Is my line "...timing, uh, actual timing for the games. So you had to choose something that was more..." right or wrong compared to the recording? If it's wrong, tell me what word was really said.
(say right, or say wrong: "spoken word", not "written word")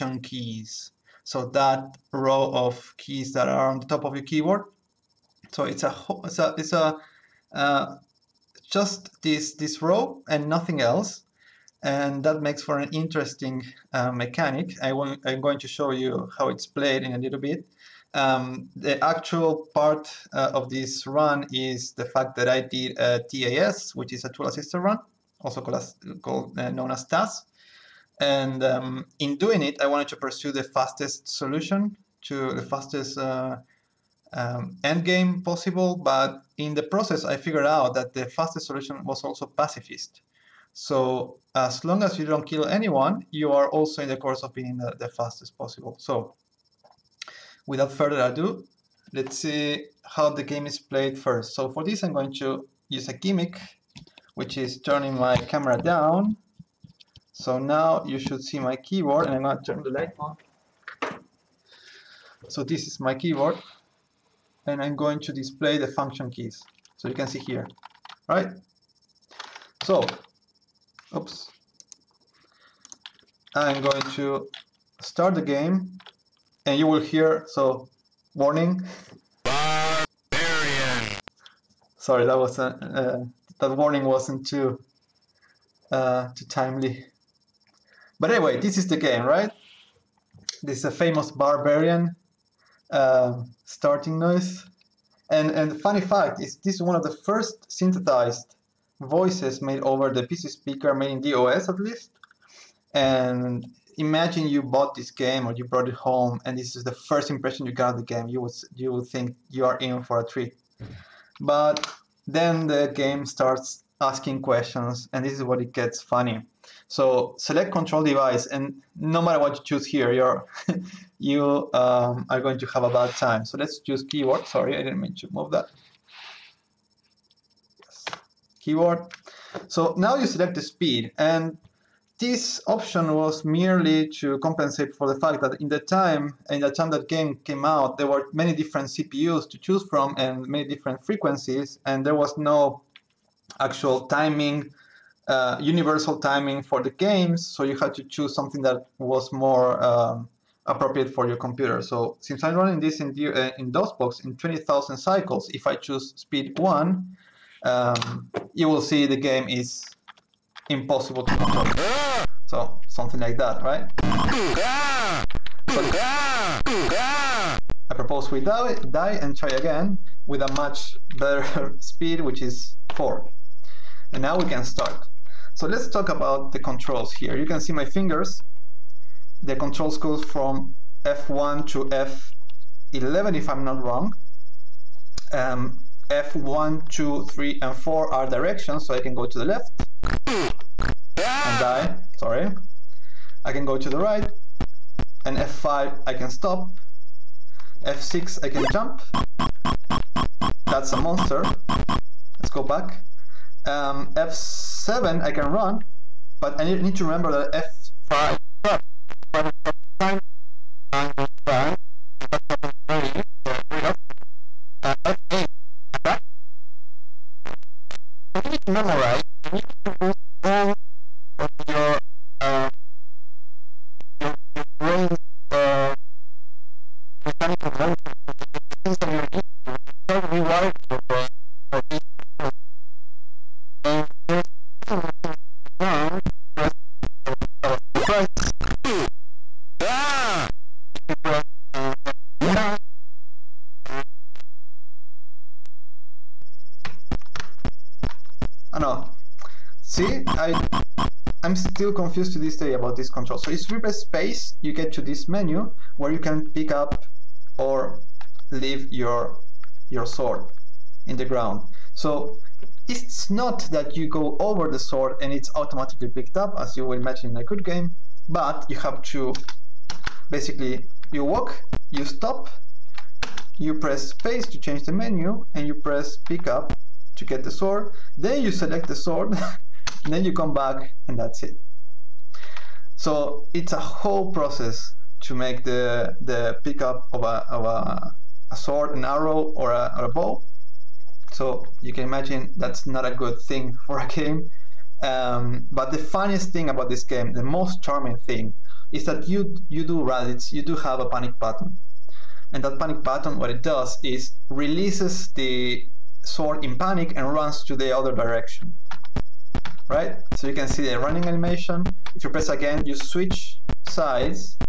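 wrong: "universal", not "actual".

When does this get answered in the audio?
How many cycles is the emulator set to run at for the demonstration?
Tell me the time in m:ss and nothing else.
2:34.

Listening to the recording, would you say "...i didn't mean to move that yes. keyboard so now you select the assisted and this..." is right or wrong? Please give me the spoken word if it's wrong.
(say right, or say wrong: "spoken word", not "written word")
wrong: "speed", not "assisted".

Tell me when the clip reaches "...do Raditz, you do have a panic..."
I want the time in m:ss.
4:59.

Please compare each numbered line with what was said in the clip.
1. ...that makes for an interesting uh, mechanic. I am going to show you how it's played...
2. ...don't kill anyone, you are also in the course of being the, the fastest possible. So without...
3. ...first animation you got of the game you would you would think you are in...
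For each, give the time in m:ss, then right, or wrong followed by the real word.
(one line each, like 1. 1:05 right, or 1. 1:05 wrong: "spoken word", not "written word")
1. 0:12 right
2. 0:42 right
3. 1:46 wrong: "impression", not "animation".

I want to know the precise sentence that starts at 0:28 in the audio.
And um, in doing it, I wanted to pursue the fastest solution to the fastest uh, um, endgame possible.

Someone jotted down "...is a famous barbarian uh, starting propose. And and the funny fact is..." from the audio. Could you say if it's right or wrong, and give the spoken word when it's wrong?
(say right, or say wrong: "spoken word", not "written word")
wrong: "noise", not "propose".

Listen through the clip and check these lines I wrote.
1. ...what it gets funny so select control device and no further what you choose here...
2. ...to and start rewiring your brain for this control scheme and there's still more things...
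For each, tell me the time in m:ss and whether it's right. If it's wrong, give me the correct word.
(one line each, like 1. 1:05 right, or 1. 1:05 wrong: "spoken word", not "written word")
1. 1:55 wrong: "matter", not "further"
2. 3:49 right.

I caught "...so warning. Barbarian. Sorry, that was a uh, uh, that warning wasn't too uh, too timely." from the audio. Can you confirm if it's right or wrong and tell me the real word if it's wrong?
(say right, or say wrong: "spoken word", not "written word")
right.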